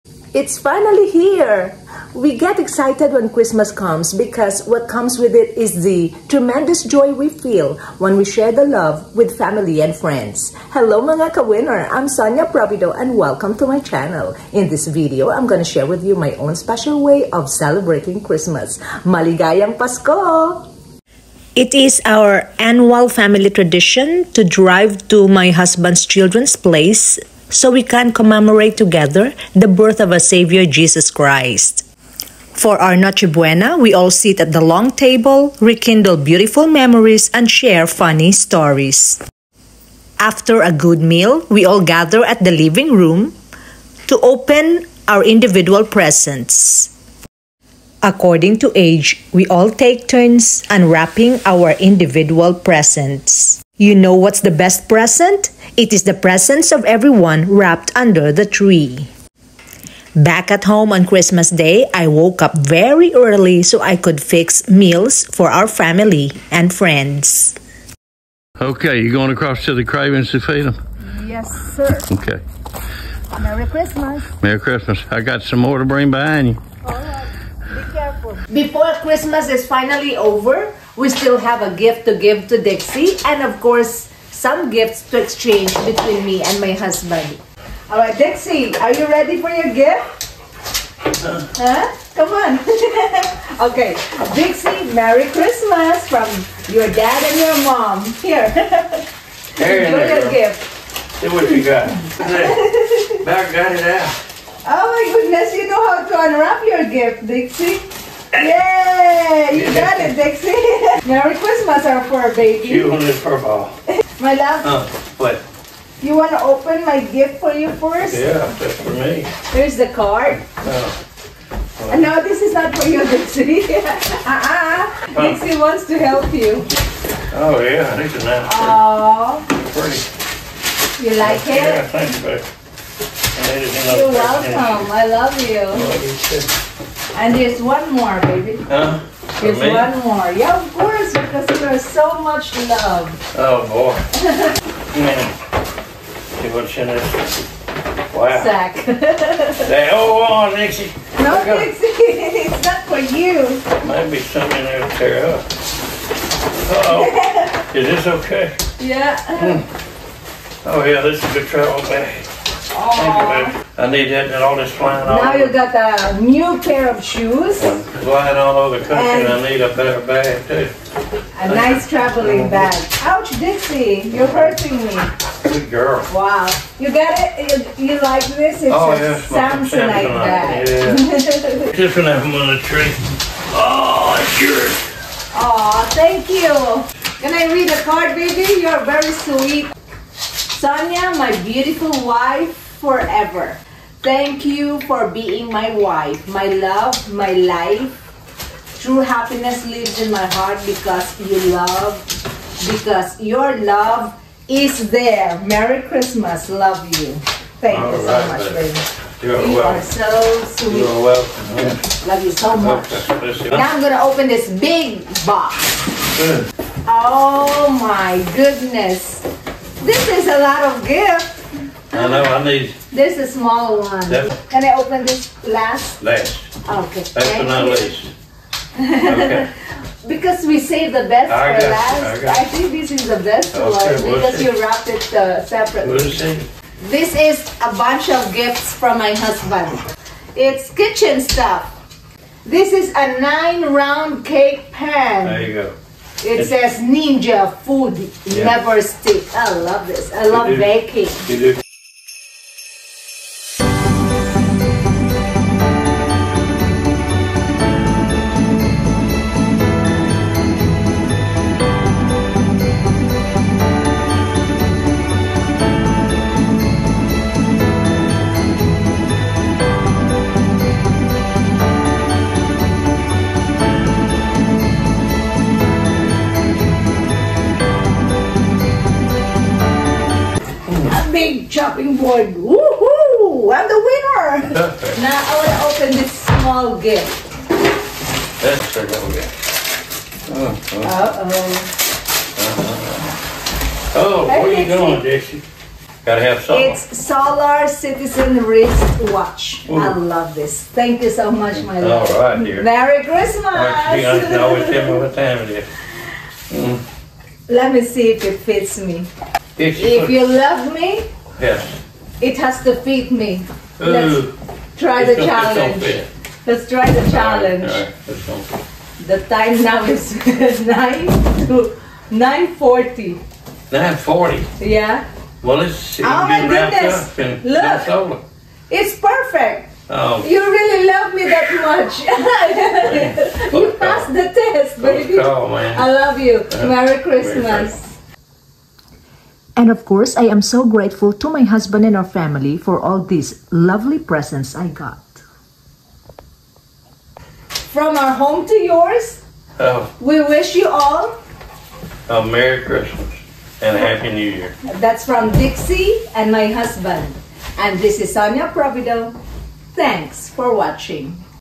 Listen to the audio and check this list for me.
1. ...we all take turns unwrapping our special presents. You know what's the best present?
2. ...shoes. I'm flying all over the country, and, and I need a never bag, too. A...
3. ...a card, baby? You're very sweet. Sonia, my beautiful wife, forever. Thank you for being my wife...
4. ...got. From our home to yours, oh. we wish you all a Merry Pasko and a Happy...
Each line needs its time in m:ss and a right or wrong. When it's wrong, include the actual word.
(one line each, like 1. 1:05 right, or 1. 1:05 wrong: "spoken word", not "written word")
1. 0:49 wrong: "individual", not "special"
2. 2:47 wrong: "better", not "never"
3. 3:07 right
4. 5:44 wrong: "Christmas", not "Pasko".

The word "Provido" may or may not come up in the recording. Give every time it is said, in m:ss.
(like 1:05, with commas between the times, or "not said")
0:12, 5:58.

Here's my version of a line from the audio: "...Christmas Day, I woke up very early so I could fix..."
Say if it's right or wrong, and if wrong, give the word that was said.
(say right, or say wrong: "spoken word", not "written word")
right.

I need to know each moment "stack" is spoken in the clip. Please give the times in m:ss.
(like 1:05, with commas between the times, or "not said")
not said.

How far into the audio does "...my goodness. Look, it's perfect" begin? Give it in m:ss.
5:26.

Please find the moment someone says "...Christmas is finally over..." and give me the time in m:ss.
1:19.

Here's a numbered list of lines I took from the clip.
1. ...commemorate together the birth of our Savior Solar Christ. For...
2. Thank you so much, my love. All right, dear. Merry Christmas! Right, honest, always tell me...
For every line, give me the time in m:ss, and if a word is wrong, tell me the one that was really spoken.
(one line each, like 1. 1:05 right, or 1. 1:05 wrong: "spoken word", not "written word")
1. 0:28 wrong: "Jesus", not "Solar"
2. 5:00 right.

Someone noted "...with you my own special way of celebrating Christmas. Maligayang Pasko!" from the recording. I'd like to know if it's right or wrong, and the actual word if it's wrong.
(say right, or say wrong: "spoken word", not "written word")
right.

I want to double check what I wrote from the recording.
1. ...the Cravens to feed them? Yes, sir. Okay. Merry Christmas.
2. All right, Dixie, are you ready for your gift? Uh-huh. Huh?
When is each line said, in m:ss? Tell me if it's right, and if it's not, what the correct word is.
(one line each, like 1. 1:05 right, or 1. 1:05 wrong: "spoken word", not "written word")
1. 1:09 right
2. 1:27 right.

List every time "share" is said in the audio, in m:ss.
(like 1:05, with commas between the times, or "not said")
0:08, 0:15, 0:37.